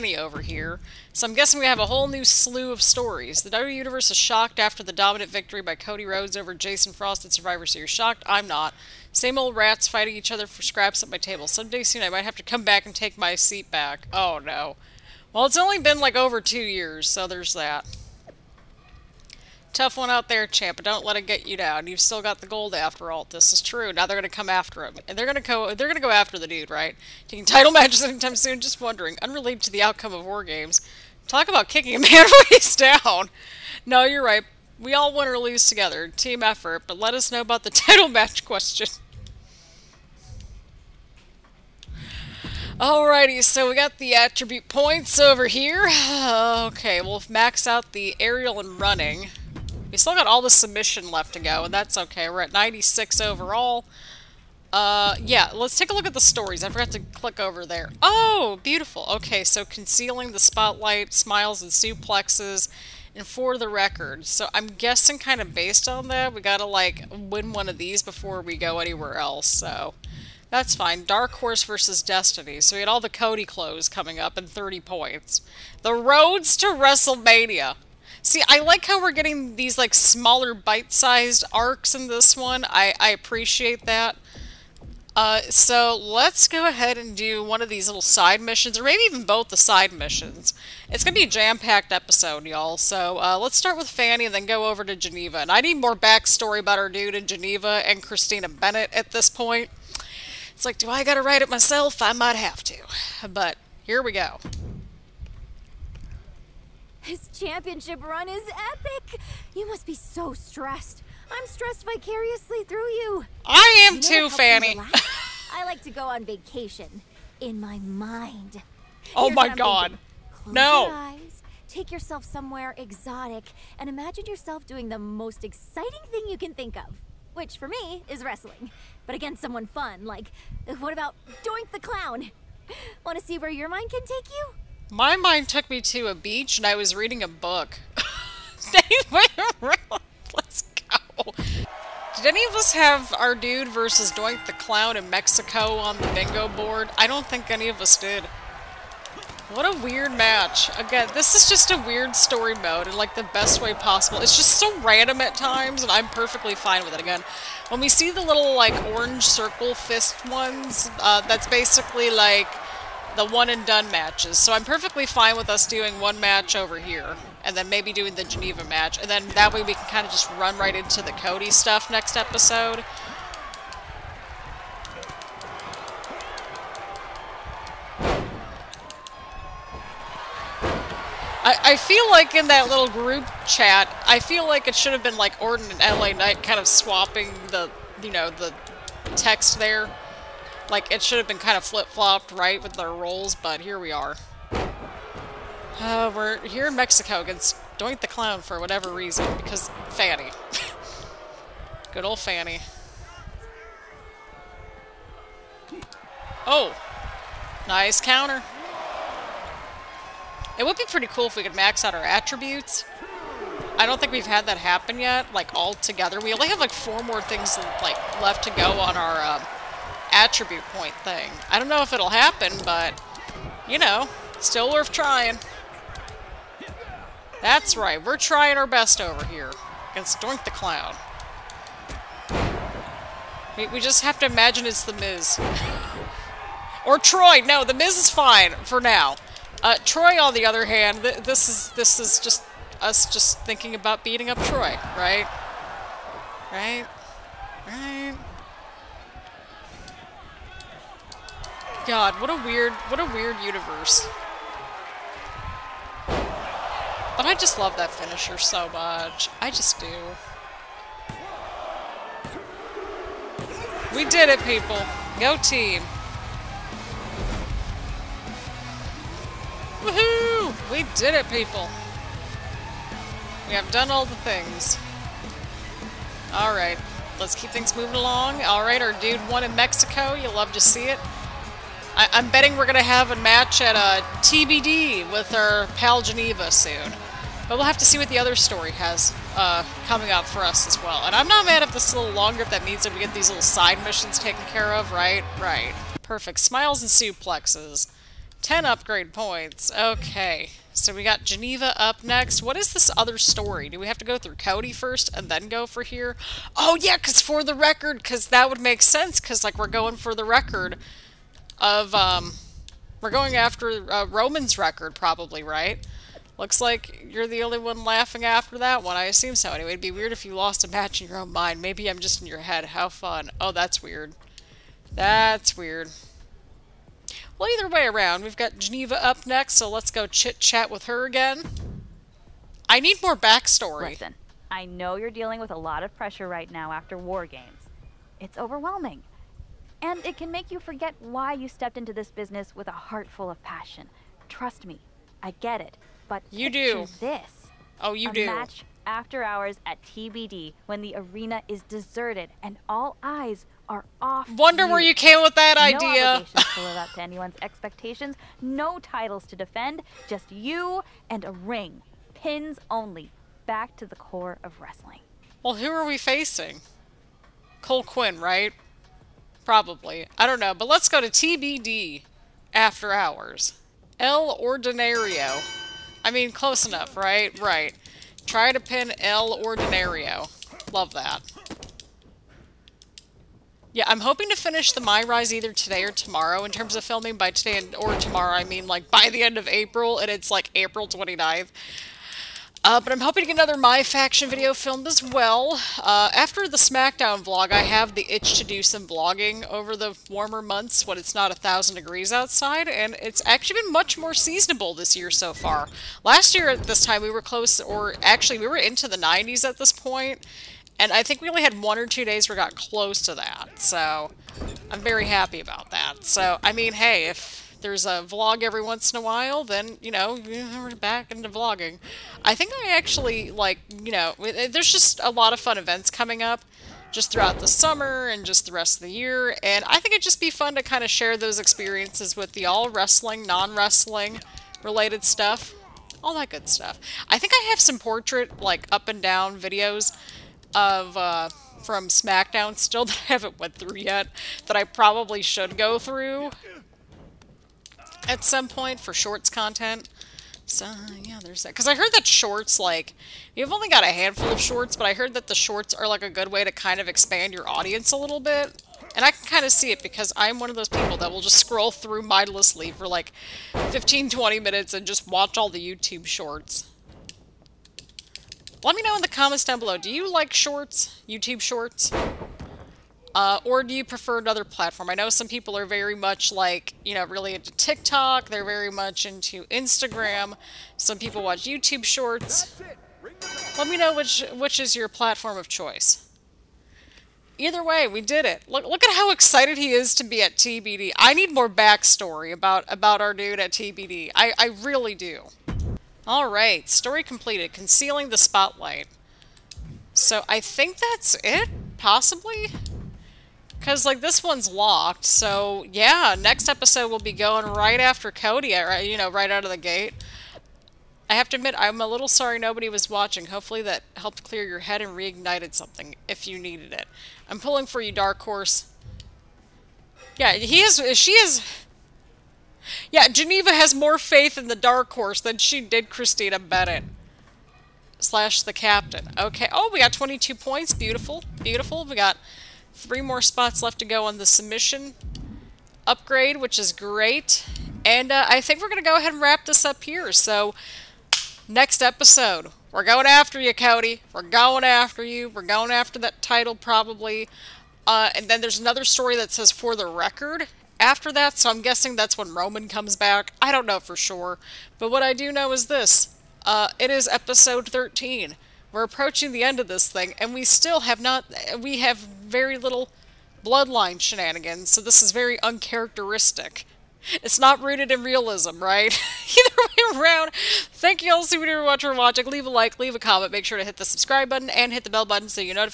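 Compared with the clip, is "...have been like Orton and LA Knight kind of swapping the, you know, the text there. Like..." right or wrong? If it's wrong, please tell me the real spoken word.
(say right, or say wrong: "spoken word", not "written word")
right.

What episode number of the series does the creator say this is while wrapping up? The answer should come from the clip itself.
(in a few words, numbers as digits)
13.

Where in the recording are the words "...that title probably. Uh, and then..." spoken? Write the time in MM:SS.
09:05.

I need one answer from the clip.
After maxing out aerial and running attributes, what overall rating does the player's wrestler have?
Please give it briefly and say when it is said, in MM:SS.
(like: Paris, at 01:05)
96, at 00:52.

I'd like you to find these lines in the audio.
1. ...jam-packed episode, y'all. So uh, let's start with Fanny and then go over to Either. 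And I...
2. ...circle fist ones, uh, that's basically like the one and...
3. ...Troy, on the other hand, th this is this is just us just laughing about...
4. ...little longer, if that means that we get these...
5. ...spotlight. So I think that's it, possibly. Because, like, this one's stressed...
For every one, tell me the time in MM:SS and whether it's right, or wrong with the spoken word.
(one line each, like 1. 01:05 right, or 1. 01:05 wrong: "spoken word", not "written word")
1. 01:31 wrong: "Geneva", not "Either"
2. 02:39 right
3. 03:59 wrong: "thinking", not "laughing"
4. 04:51 right
5. 08:18 wrong: "locked", not "stressed".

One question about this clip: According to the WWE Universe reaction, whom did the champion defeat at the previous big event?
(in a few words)
Jason Frost.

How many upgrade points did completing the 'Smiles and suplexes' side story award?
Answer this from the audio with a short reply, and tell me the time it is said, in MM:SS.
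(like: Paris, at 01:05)
10, at 04:58.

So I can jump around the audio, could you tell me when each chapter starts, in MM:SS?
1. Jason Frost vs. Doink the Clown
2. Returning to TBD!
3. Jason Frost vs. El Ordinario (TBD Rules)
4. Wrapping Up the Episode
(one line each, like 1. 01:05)
1. 02:19
2. 04:53
3. 06:10
4. 08:12.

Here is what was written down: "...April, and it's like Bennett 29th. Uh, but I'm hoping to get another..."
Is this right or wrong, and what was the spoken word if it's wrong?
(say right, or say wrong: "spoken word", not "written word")
wrong: "April", not "Bennett".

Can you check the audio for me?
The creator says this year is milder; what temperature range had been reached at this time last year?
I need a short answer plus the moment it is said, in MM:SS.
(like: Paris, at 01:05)
the 90s, at 06:48.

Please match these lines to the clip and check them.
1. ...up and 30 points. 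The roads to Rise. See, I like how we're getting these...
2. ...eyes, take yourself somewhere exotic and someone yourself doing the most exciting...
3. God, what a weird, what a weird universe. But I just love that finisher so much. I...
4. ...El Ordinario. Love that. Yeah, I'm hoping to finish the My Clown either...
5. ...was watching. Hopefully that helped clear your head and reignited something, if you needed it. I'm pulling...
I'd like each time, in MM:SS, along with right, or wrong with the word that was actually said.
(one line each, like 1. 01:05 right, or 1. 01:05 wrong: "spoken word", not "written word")
1. 01:14 wrong: "WrestleMania", not "Rise"
2. 02:00 wrong: "imagine", not "someone"
3. 04:11 right
4. 06:18 wrong: "Rise", not "Clown"
5. 08:32 right.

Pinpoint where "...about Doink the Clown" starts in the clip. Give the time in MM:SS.
02:10.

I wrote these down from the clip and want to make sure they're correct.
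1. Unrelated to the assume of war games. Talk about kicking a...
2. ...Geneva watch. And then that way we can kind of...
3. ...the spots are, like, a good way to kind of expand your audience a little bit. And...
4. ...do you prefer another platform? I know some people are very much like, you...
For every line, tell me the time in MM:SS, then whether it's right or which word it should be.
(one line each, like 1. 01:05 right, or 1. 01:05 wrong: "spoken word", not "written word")
1. 00:29 wrong: "outcome", not "assume"
2. 02:48 wrong: "match", not "watch"
3. 07:35 wrong: "shorts", not "spots"
4. 07:53 right.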